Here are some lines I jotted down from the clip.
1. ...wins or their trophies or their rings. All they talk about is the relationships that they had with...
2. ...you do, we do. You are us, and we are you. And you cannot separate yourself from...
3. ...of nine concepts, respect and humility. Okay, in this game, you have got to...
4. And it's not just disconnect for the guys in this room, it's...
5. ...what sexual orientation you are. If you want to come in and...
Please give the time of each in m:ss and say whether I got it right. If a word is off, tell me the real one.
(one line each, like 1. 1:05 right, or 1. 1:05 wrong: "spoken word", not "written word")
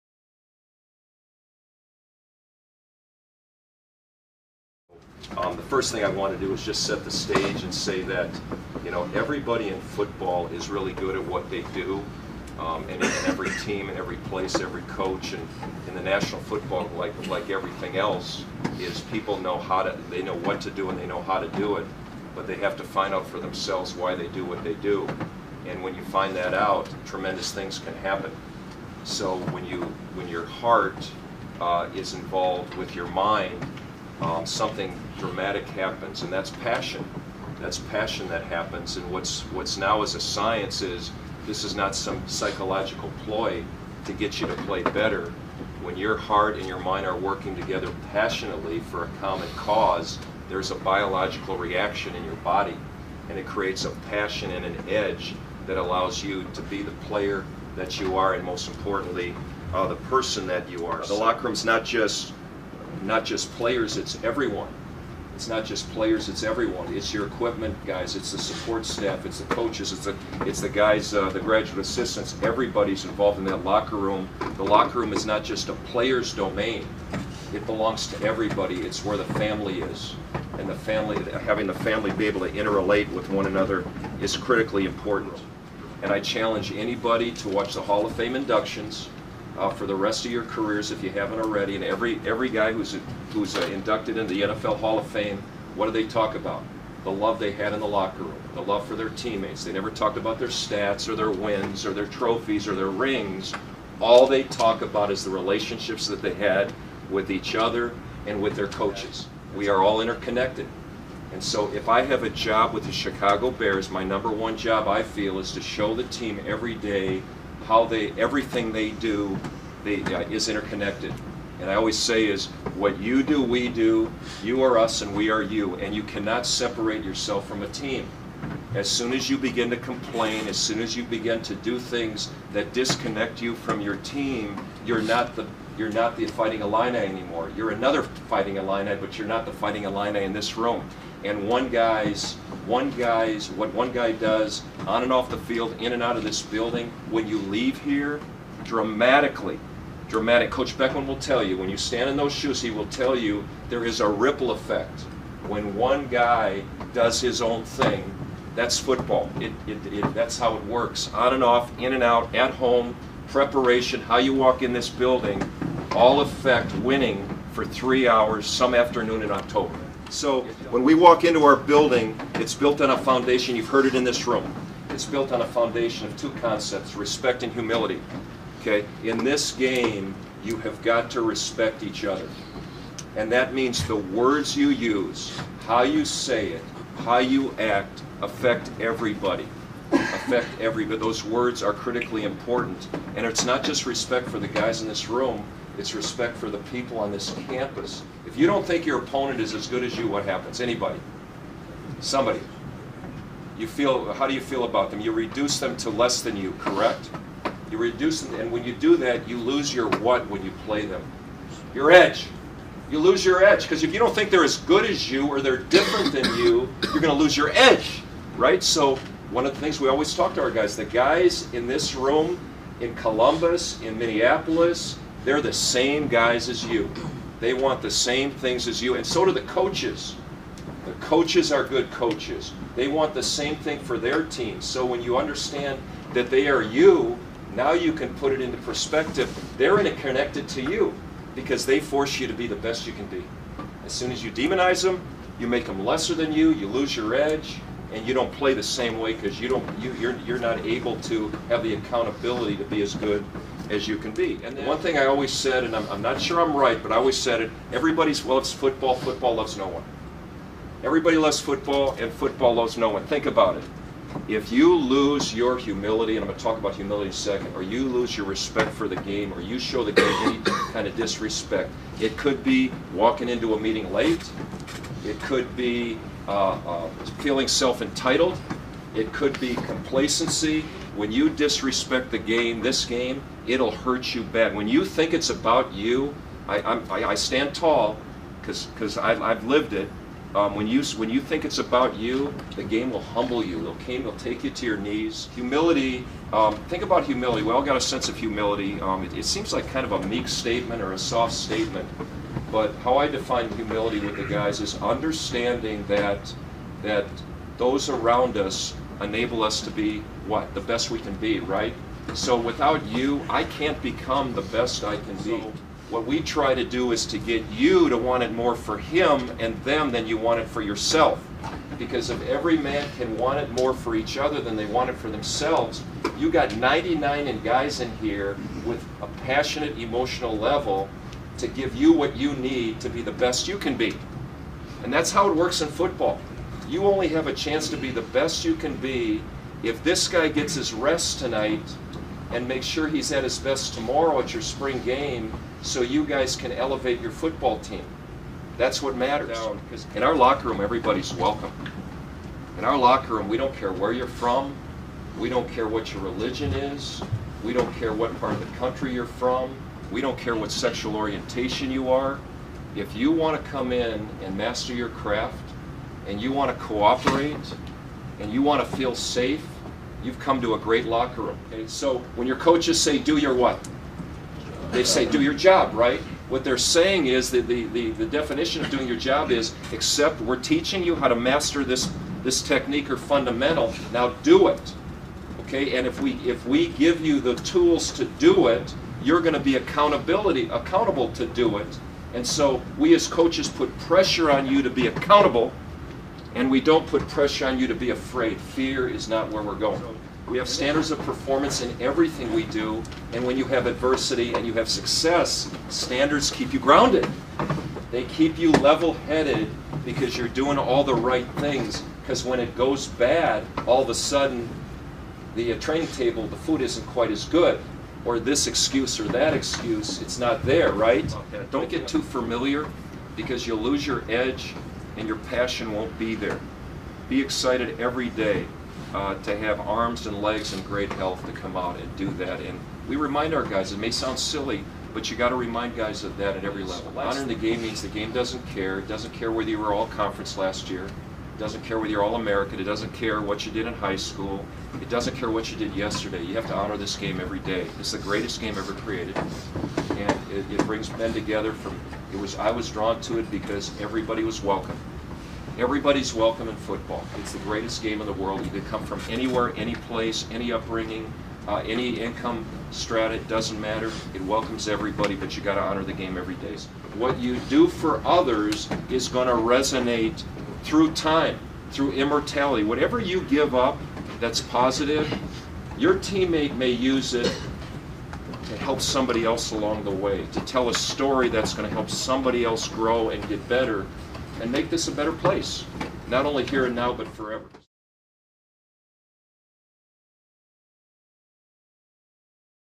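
1. 1:41 right
2. 2:02 right
3. 2:56 wrong: "two", not "nine"
4. 3:13 wrong: "respect", not "disconnect"
5. 6:00 right.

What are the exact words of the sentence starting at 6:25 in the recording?
Okay, and if we, if we give you the tools to do it, you're going to be accountability accountable to do it.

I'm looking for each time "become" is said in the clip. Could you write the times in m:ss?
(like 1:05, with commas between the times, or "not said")
5:13.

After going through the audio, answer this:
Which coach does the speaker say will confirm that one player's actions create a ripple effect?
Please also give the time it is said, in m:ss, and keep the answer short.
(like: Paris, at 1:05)
Coach Beckman, at 2:30.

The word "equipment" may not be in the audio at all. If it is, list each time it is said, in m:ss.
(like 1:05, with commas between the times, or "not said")
1:07.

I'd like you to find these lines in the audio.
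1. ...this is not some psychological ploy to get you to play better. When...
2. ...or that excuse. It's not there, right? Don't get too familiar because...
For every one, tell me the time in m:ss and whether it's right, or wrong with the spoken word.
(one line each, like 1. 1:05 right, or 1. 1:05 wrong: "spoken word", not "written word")
1. 0:41 right
2. 6:58 right.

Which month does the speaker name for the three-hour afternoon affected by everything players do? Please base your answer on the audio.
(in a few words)
October.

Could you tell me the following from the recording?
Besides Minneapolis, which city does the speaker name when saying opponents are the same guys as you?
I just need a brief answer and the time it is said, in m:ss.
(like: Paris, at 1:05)
Columbus, at 3:42.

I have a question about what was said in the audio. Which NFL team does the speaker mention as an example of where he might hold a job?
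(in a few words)
Chicago Bears.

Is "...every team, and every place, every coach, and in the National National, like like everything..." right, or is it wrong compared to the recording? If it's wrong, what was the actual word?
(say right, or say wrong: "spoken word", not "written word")
wrong: "Football", not "National".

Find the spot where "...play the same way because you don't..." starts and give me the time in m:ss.
4:08.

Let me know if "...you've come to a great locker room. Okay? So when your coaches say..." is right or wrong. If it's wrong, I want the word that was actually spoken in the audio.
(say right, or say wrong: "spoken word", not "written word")
right.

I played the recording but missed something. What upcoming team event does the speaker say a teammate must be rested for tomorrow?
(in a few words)
Spring game.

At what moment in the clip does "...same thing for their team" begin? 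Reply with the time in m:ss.
3:53.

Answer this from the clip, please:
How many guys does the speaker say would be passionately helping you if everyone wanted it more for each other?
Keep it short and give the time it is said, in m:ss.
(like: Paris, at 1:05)
99, at 5:26.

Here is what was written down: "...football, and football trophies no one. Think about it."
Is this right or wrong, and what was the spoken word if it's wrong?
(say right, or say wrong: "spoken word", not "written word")
wrong: "loves", not "trophies".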